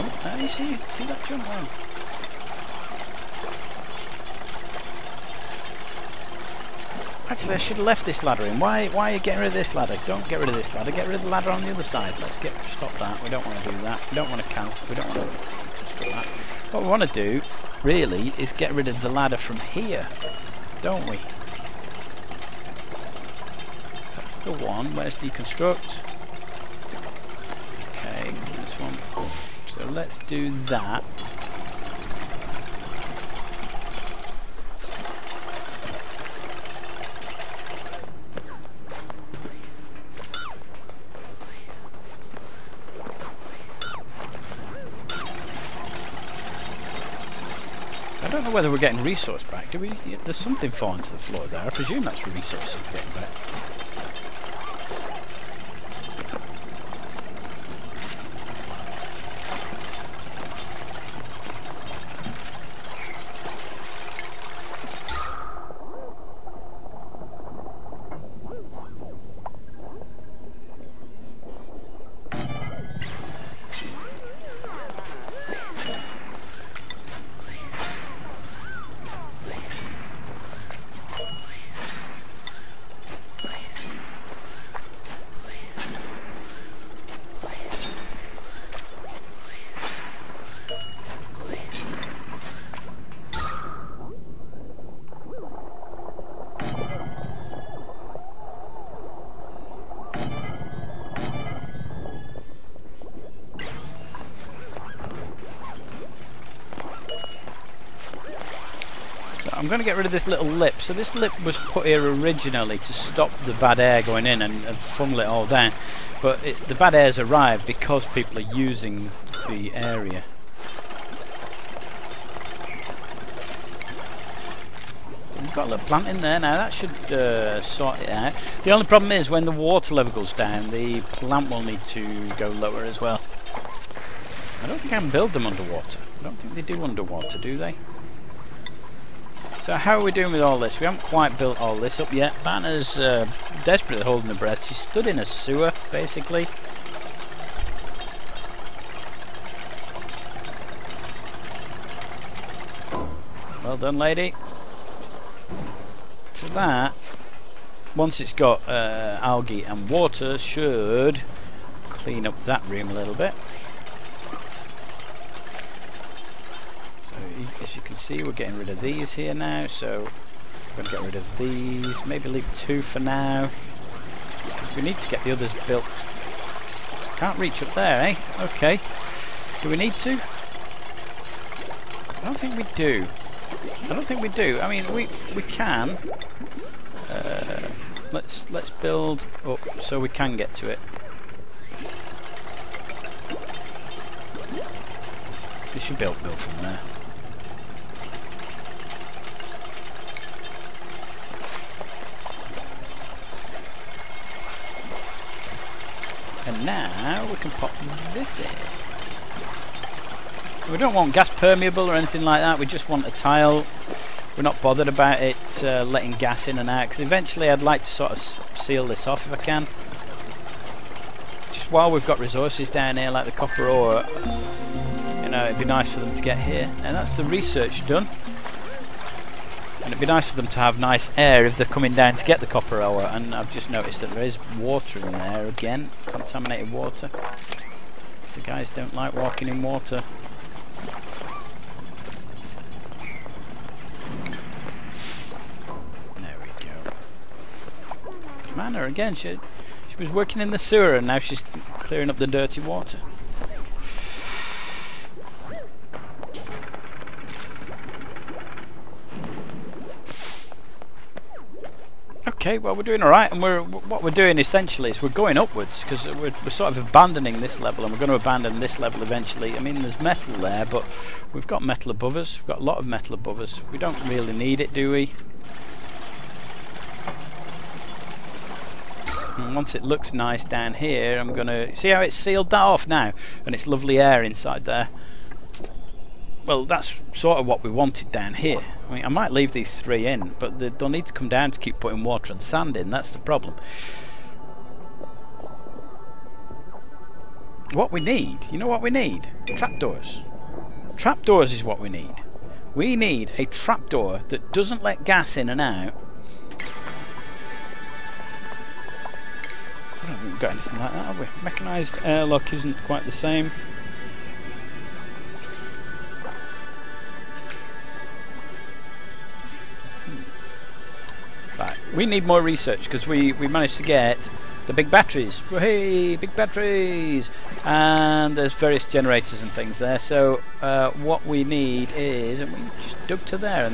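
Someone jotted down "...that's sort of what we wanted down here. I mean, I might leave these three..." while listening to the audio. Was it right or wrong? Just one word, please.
right.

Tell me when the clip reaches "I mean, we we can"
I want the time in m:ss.
3:04.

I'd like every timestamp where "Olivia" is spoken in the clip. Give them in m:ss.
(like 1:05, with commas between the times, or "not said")
not said.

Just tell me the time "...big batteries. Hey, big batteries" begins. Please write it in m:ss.
5:24.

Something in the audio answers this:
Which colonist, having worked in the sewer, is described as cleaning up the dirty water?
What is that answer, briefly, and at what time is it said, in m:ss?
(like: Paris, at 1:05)
Manor, at 4:08.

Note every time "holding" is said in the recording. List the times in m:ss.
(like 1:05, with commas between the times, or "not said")
2:24.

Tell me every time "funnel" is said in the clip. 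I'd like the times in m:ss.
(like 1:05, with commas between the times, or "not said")
1:54.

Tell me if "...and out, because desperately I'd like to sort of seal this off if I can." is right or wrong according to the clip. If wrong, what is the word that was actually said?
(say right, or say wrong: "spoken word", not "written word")
wrong: "eventually", not "desperately".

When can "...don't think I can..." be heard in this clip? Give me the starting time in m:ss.
2:14.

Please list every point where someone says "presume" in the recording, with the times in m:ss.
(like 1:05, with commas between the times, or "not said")
0:51.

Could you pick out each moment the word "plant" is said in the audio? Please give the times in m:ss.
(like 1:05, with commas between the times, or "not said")
2:05, 2:11.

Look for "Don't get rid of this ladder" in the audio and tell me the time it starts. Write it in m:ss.
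0:10.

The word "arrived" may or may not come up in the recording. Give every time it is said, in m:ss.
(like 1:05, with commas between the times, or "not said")
1:57.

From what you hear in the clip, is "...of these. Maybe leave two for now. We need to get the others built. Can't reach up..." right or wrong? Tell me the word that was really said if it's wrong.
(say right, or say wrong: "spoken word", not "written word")
right.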